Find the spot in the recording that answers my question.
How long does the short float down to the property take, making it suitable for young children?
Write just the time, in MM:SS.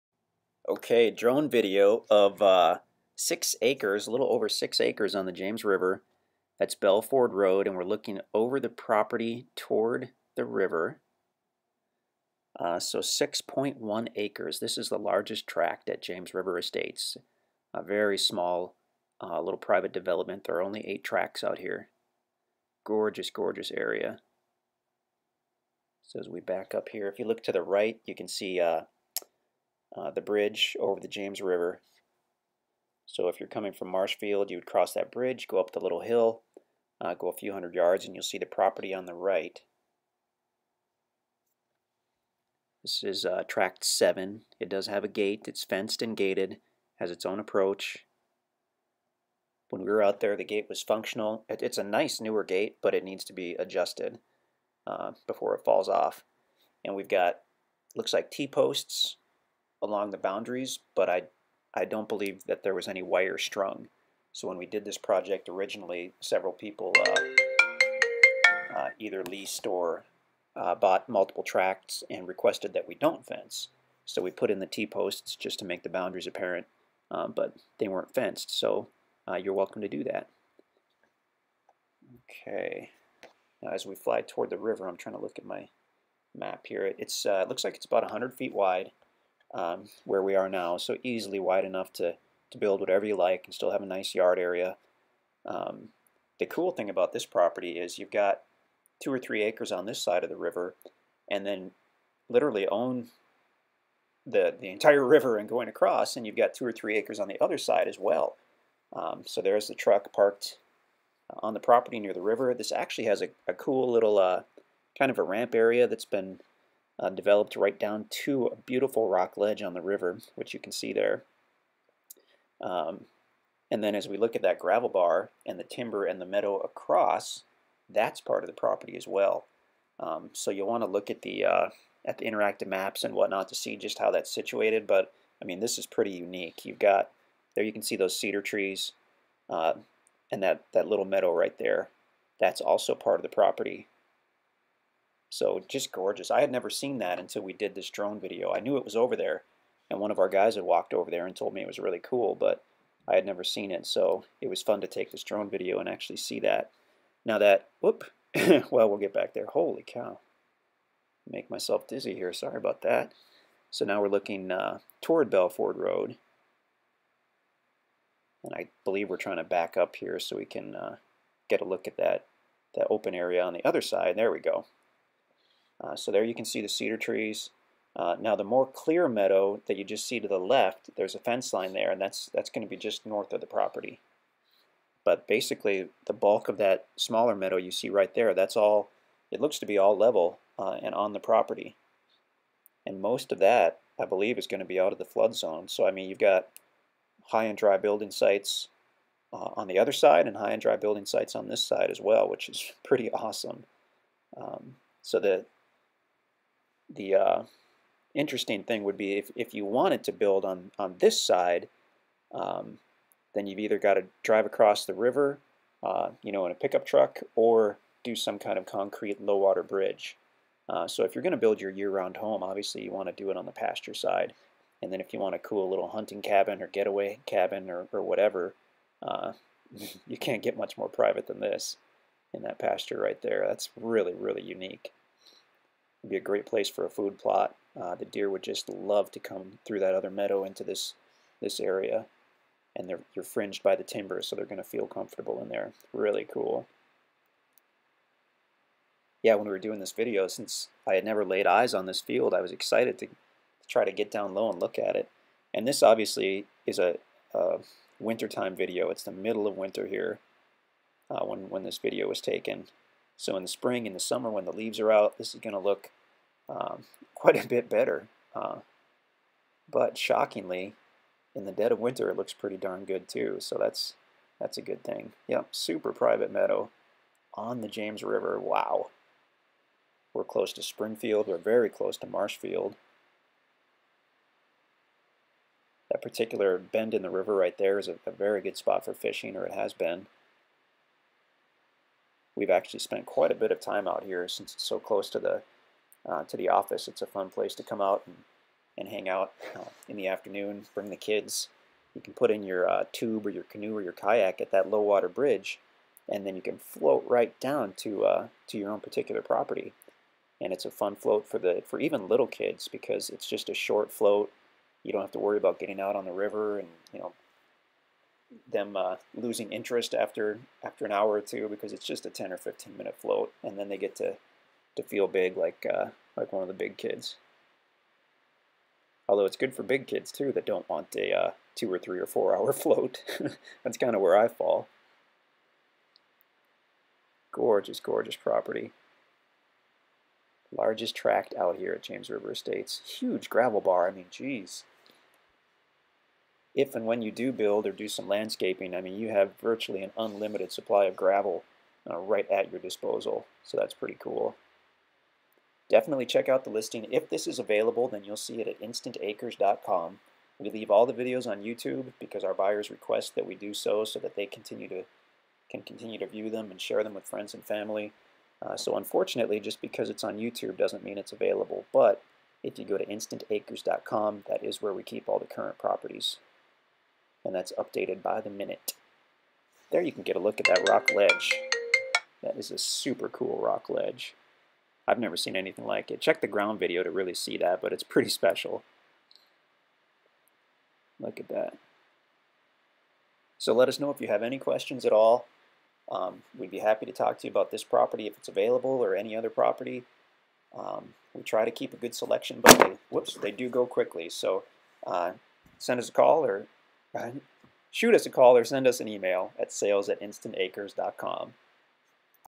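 05:22.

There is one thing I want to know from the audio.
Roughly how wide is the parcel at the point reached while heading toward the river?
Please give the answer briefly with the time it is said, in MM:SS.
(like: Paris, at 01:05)
100 feet, at 01:28.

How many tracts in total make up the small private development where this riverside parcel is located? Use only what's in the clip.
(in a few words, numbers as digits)
8.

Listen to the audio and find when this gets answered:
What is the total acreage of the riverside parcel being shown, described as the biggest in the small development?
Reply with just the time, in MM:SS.
00:12.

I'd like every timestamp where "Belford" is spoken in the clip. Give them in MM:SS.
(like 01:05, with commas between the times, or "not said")
00:06, 02:45.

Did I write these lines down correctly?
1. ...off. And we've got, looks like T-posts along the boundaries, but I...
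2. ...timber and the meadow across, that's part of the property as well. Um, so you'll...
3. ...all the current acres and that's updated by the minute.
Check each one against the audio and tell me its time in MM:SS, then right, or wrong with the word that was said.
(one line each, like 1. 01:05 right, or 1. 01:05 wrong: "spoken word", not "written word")
1. 00:55 right
2. 02:05 right
3. 06:15 wrong: "properties", not "acres".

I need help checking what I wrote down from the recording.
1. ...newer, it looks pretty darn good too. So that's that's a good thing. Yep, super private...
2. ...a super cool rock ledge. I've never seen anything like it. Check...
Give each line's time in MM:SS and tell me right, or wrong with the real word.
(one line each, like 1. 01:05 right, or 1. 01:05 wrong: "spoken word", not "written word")
1. 04:31 wrong: "winter", not "newer"
2. 06:22 right.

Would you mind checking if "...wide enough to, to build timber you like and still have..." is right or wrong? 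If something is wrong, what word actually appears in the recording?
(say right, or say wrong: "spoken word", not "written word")
wrong: "whatever", not "timber".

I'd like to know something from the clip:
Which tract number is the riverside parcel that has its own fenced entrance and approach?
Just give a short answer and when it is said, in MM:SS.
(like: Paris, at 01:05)
Tract 7, at 00:43.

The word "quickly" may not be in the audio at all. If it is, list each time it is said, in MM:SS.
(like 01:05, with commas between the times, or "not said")
06:43.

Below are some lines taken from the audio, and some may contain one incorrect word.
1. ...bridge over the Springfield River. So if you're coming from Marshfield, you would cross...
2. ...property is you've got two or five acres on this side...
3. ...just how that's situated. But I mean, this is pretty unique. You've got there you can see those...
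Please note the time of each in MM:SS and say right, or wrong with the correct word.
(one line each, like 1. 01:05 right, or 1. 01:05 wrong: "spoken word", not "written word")
1. 00:30 wrong: "James", not "Springfield"
2. 01:37 wrong: "three", not "five"
3. 02:13 right.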